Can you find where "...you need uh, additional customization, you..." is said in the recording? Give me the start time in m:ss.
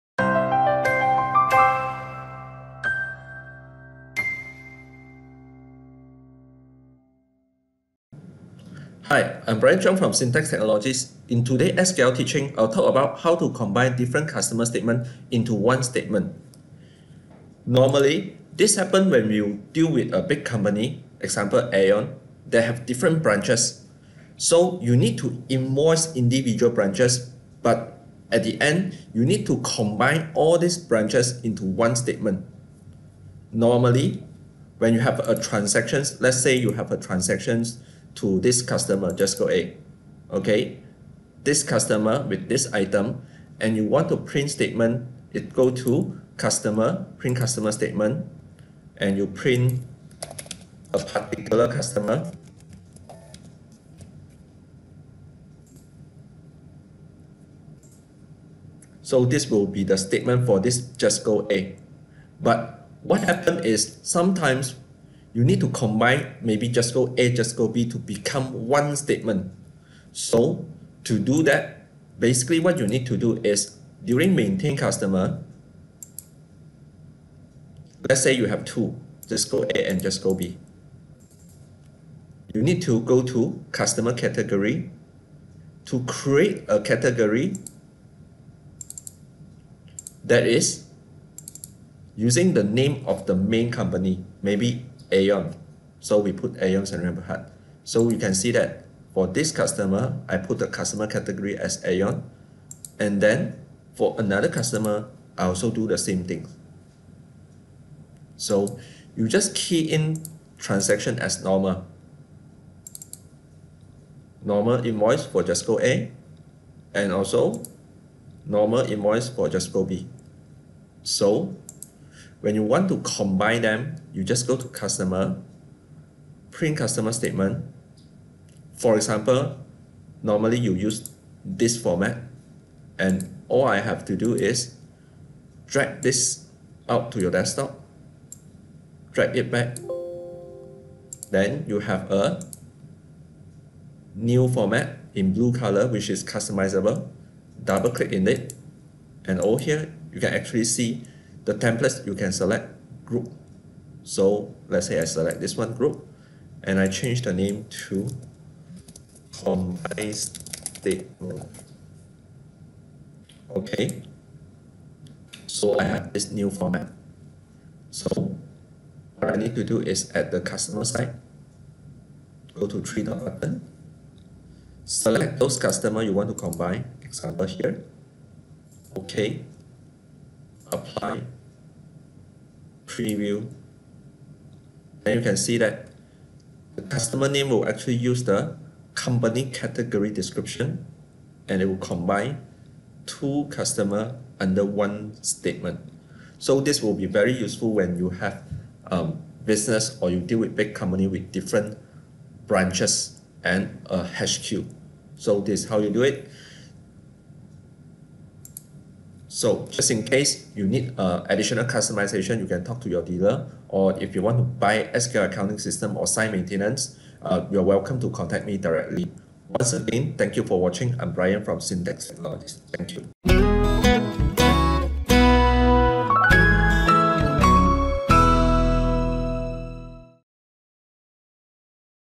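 3:30.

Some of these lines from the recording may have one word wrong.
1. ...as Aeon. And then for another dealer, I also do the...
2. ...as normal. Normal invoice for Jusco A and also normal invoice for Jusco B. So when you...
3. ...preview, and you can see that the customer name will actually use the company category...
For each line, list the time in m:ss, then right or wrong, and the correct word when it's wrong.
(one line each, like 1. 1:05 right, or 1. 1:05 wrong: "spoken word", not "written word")
1. 1:41 wrong: "customer", not "dealer"
2. 1:51 right
3. 3:02 right.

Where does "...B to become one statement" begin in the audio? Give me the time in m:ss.
1:07.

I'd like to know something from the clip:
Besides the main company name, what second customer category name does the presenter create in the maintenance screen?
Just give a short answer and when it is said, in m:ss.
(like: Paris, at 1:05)
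Rainbow Heart, at 1:37.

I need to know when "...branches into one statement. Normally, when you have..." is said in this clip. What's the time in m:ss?
0:30.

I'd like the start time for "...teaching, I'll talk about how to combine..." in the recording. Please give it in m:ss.
0:12.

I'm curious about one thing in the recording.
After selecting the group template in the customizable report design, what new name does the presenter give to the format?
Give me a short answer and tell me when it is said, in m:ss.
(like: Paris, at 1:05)
Combined statement, at 2:39.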